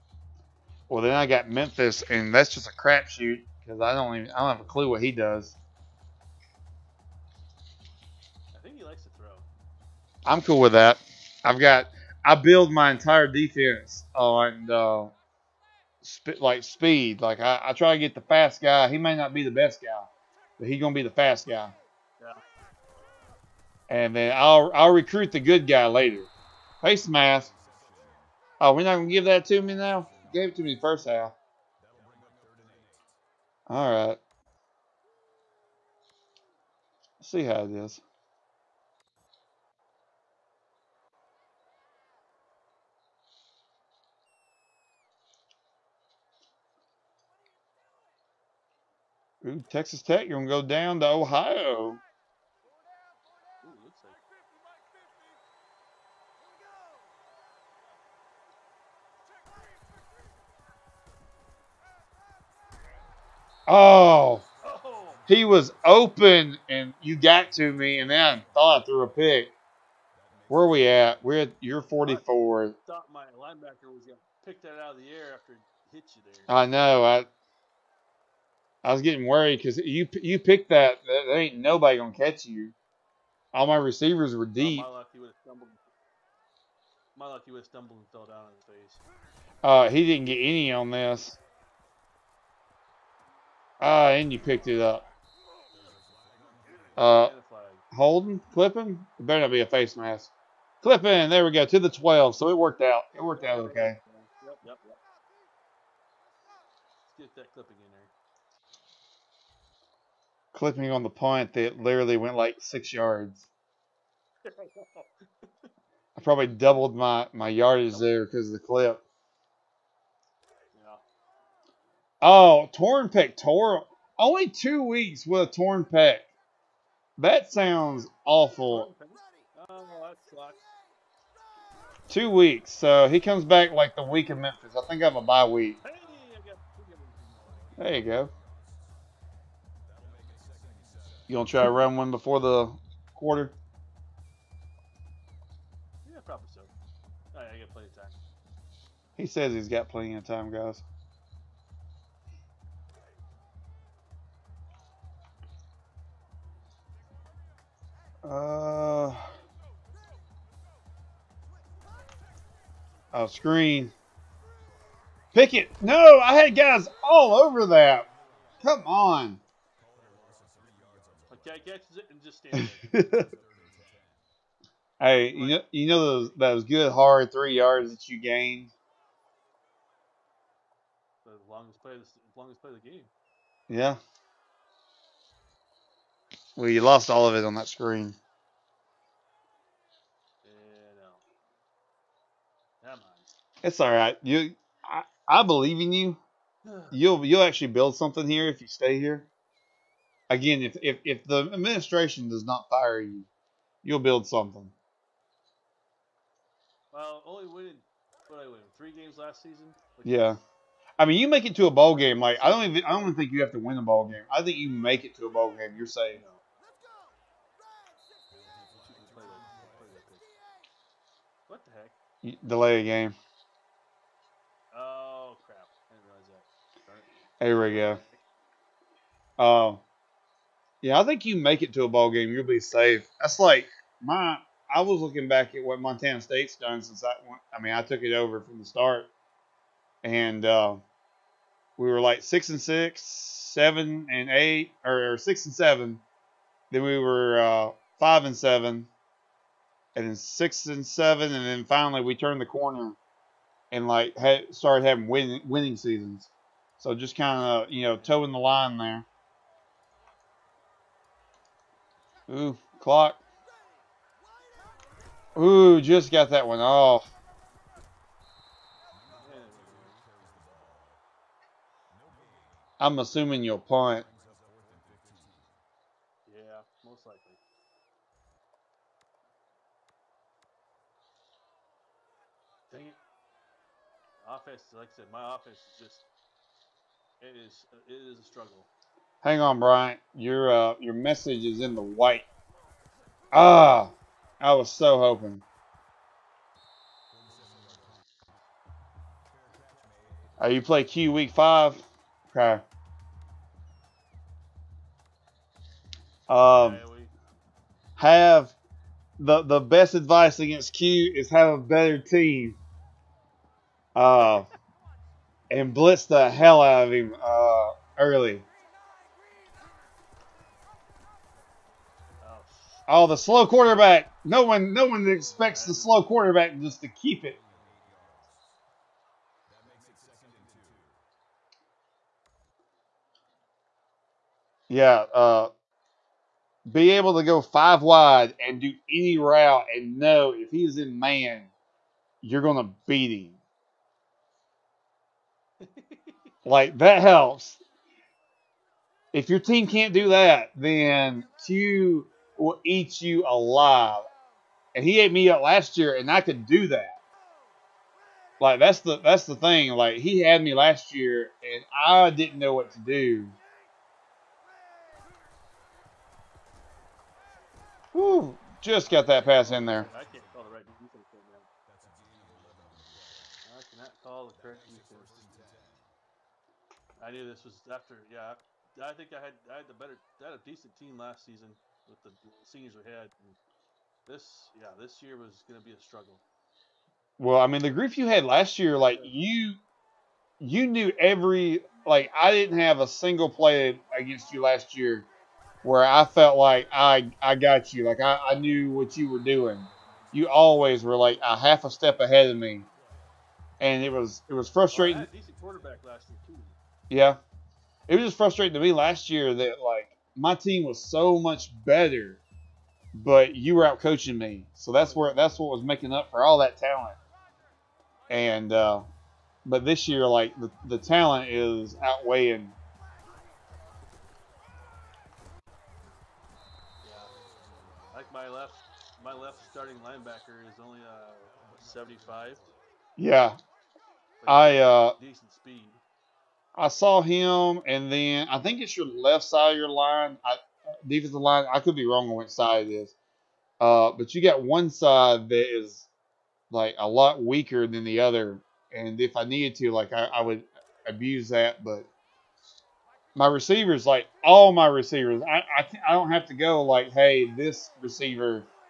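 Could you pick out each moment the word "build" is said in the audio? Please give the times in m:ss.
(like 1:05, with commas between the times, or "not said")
0:12, 3:17, 3:23.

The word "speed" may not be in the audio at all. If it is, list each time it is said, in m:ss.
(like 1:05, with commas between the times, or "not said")
0:16, 7:15.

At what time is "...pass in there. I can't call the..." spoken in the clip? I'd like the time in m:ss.
6:09.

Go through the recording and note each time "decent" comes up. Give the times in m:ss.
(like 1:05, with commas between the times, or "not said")
6:20, 6:45, 7:15.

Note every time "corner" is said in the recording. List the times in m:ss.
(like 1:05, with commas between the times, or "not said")
4:12.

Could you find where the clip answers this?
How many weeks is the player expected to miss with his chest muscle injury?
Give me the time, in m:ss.
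2:04.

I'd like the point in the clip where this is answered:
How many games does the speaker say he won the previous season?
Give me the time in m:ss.
3:28.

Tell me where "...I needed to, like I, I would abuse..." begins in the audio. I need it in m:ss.
7:29.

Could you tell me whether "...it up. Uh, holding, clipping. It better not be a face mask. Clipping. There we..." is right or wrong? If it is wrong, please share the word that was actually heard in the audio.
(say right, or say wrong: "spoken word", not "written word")
right.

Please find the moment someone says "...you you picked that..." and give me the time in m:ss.
1:19.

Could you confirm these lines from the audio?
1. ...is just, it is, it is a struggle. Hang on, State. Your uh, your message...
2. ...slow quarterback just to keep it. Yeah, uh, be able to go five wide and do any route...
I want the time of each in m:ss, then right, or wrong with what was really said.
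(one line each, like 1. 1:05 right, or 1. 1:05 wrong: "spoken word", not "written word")
1. 4:45 wrong: "Brian", not "State"
2. 5:25 right.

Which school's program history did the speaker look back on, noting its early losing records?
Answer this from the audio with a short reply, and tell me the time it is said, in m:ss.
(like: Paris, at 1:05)
Montana State, at 3:55.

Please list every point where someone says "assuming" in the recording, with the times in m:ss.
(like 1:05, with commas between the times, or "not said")
4:32.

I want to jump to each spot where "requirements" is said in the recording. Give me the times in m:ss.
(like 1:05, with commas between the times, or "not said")
not said.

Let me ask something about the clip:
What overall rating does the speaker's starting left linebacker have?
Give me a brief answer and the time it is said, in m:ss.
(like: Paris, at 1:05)
75, at 7:11.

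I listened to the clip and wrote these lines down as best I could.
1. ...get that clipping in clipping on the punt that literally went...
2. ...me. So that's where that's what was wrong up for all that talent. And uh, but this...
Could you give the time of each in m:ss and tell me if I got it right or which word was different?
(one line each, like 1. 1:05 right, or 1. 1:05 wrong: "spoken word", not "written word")
1. 1:47 right
2. 6:54 wrong: "making", not "wrong".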